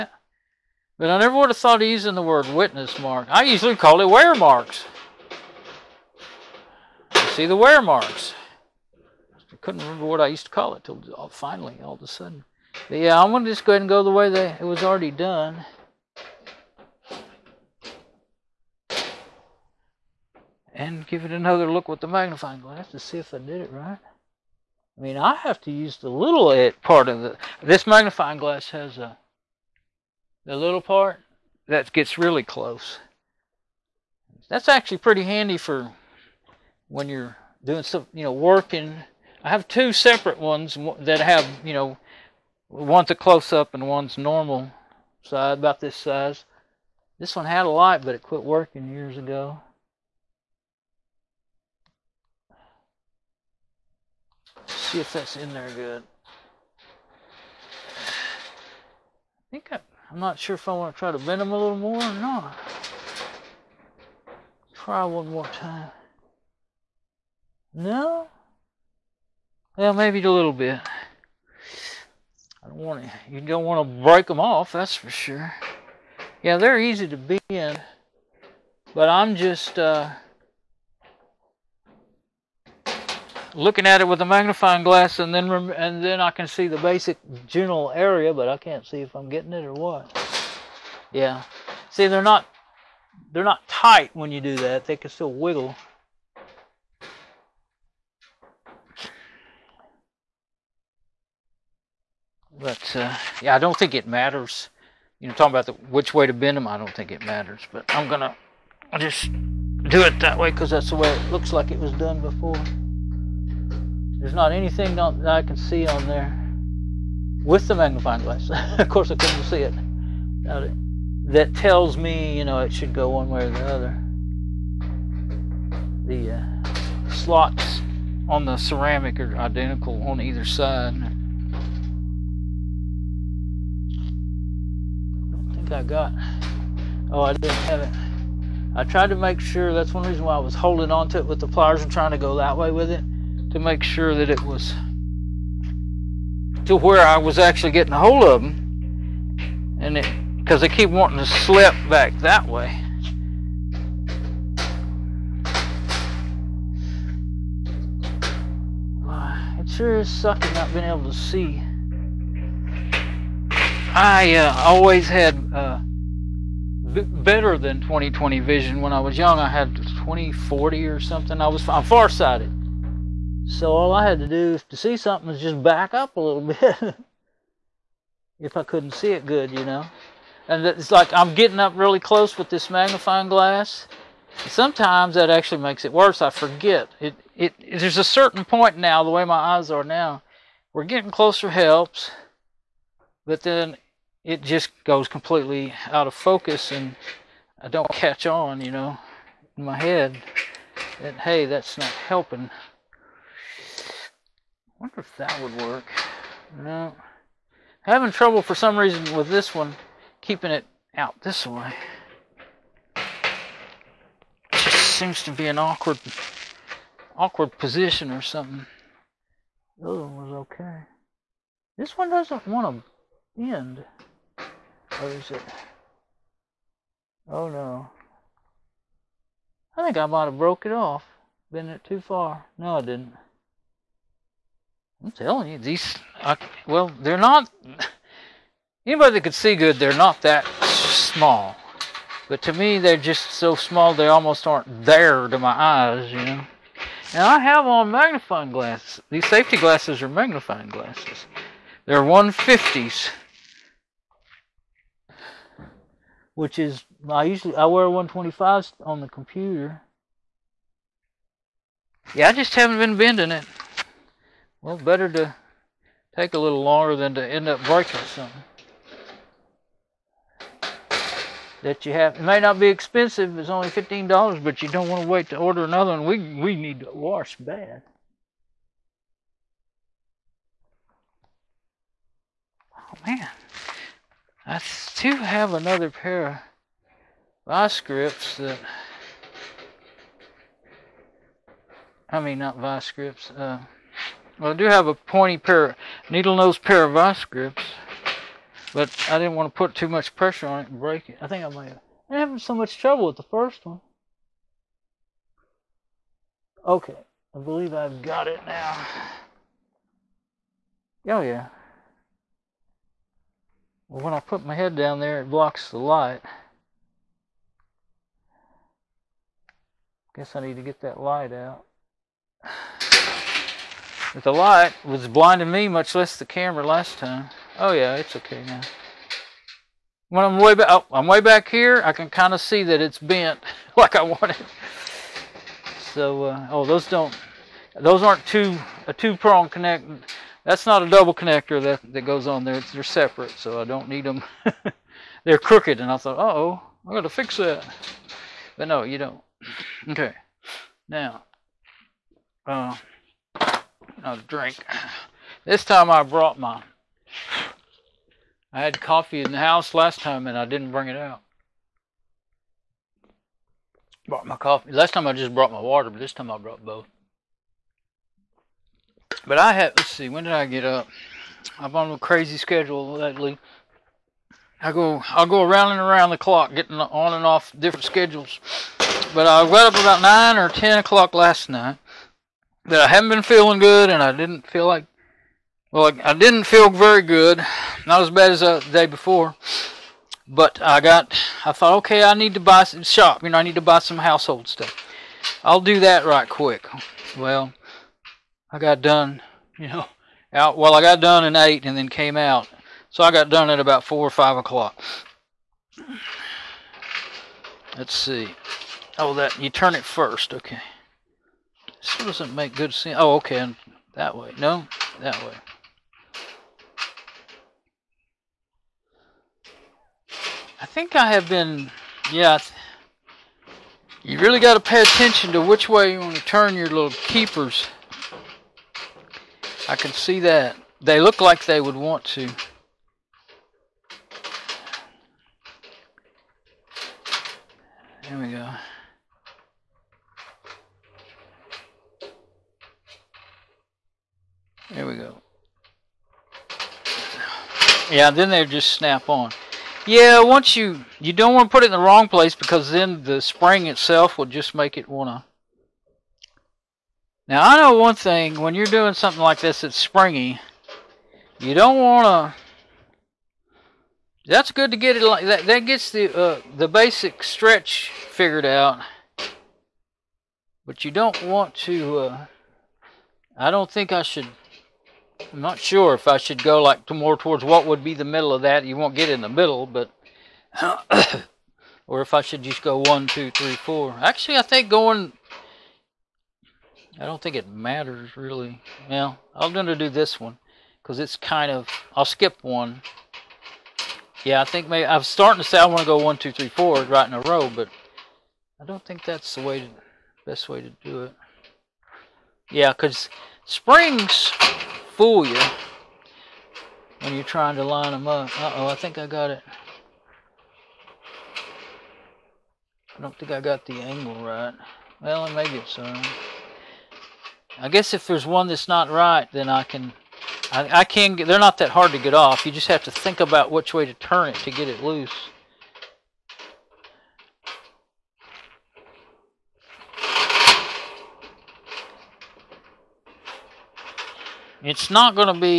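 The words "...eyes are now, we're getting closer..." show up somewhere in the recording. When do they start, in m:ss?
3:09.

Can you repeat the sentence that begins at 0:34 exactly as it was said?
That's actually pretty handy for when you're doing some, you know, working.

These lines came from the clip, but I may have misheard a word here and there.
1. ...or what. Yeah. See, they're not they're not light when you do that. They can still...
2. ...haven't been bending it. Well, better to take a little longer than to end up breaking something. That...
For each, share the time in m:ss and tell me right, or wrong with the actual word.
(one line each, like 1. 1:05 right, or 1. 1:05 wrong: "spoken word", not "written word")
1. 1:29 wrong: "tight", not "light"
2. 4:22 right.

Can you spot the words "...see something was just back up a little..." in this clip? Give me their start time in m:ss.
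2:54.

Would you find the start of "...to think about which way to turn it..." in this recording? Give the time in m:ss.
8:42.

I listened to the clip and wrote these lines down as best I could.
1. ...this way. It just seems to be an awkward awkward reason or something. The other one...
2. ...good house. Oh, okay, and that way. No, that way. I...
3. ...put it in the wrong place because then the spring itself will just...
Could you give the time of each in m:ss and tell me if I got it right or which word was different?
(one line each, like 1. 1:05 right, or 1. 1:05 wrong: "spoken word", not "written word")
1. 3:31 wrong: "position", not "reason"
2. 6:52 wrong: "sense", not "house"
3. 7:31 right.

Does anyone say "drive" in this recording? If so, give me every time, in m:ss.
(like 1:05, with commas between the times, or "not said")
not said.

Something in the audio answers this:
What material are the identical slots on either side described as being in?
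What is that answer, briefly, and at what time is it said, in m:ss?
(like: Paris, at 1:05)
ceramic, at 2:08.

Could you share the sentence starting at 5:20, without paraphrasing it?
Guess I need to get that light out.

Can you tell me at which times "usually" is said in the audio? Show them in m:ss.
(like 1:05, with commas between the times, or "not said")
0:03, 4:17.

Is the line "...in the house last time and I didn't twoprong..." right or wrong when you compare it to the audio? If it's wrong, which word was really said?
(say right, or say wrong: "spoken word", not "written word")
wrong: "bring", not "twoprong".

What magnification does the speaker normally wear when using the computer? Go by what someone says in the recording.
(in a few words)
125s.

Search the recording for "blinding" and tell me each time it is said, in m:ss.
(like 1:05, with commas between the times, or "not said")
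5:25.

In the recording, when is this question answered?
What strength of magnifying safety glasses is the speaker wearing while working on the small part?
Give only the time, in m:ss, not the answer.
4:12.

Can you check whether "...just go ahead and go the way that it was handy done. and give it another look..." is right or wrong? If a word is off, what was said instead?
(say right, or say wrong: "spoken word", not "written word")
wrong: "already", not "handy".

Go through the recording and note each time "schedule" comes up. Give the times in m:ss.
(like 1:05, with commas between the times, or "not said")
6:12, 6:17.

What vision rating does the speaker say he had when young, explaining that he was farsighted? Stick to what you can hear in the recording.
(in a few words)
20/40.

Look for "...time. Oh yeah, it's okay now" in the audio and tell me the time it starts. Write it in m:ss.
5:26.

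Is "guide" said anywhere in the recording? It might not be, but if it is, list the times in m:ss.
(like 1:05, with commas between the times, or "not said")
not said.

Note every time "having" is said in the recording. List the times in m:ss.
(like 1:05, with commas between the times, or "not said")
3:27, 5:02.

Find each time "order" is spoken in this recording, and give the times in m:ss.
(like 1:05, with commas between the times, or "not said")
4:35.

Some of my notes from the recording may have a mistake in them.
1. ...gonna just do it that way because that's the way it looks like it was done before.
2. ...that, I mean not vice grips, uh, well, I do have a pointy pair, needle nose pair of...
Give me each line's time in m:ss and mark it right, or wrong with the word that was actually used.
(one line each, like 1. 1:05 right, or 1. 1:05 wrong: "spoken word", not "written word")
1. 1:48 right
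2. 4:48 right.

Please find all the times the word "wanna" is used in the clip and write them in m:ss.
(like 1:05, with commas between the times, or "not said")
7:34, 7:41.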